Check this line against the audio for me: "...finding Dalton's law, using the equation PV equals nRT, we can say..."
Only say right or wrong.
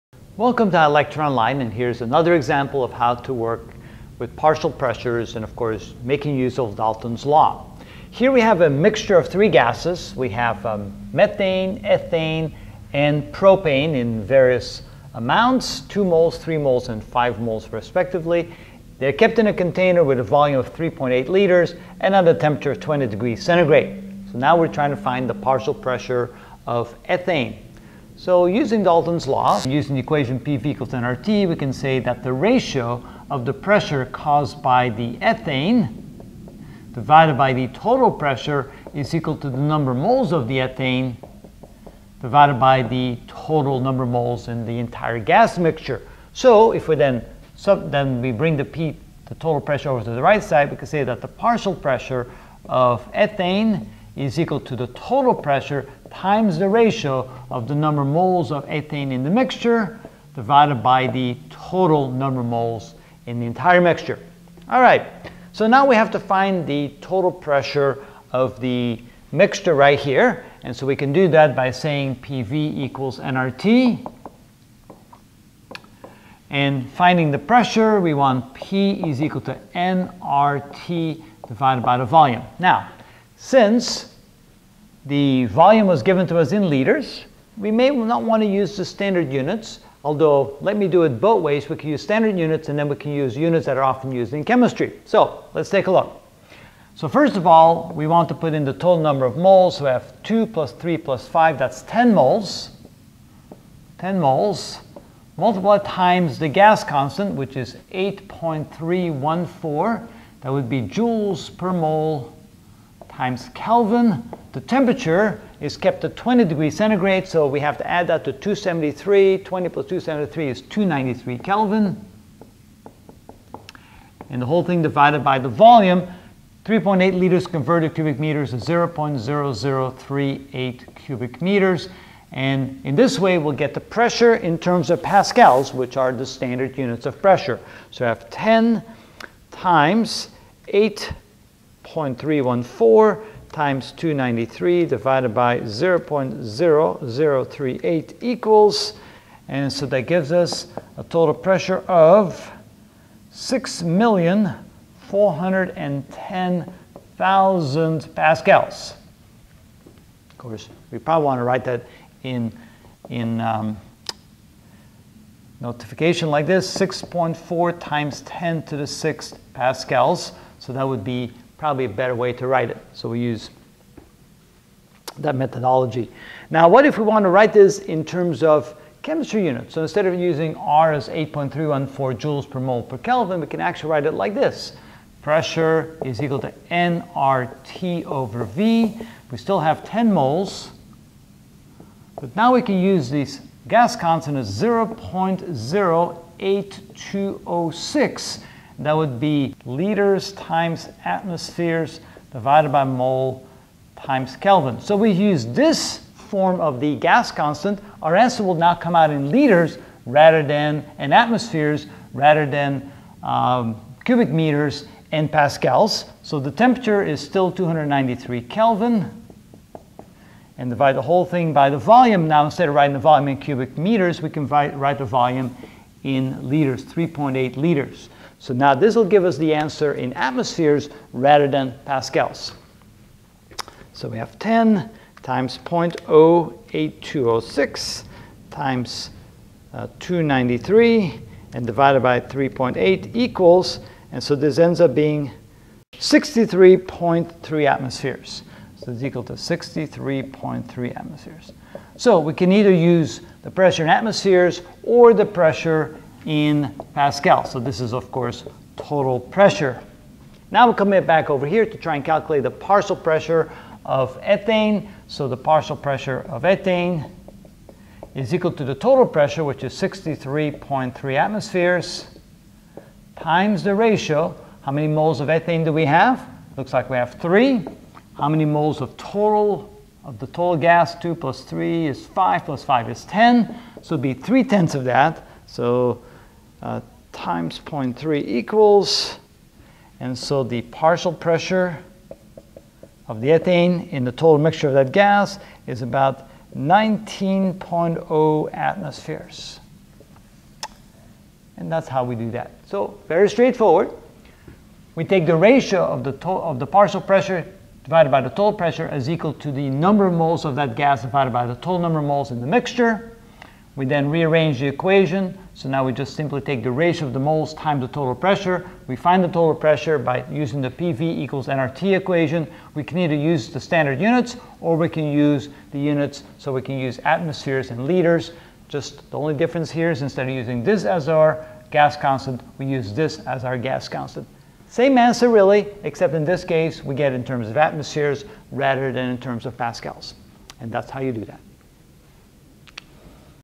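wrong.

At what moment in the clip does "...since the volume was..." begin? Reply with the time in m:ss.
1:23.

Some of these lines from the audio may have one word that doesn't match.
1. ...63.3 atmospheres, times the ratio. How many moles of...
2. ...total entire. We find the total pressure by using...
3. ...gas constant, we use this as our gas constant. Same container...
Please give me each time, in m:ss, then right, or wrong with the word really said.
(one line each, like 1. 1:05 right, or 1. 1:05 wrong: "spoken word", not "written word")
1. 4:29 right
2. 5:17 wrong: "pressure", not "entire"
3. 5:31 wrong: "answer", not "container".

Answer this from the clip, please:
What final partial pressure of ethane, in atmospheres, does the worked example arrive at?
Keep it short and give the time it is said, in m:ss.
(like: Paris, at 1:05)
19.0 atmospheres, at 4:56.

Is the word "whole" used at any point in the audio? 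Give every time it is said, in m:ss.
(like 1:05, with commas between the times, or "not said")
2:04, 3:41.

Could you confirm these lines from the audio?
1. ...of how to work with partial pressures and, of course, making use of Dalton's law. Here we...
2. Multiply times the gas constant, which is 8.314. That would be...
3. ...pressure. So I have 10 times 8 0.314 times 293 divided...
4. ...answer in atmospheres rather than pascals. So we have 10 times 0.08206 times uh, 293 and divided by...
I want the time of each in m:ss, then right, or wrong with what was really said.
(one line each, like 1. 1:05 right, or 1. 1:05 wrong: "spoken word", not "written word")
1. 0:02 right
2. 1:45 right
3. 2:17 right
4. 3:49 right.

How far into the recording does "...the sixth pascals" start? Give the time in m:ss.
2:48.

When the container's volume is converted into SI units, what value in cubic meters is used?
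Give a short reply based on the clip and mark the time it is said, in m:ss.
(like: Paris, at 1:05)
0.0038 cubic meters, at 2:08.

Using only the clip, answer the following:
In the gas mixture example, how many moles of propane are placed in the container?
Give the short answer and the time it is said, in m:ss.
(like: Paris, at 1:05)
5 moles, at 0:17.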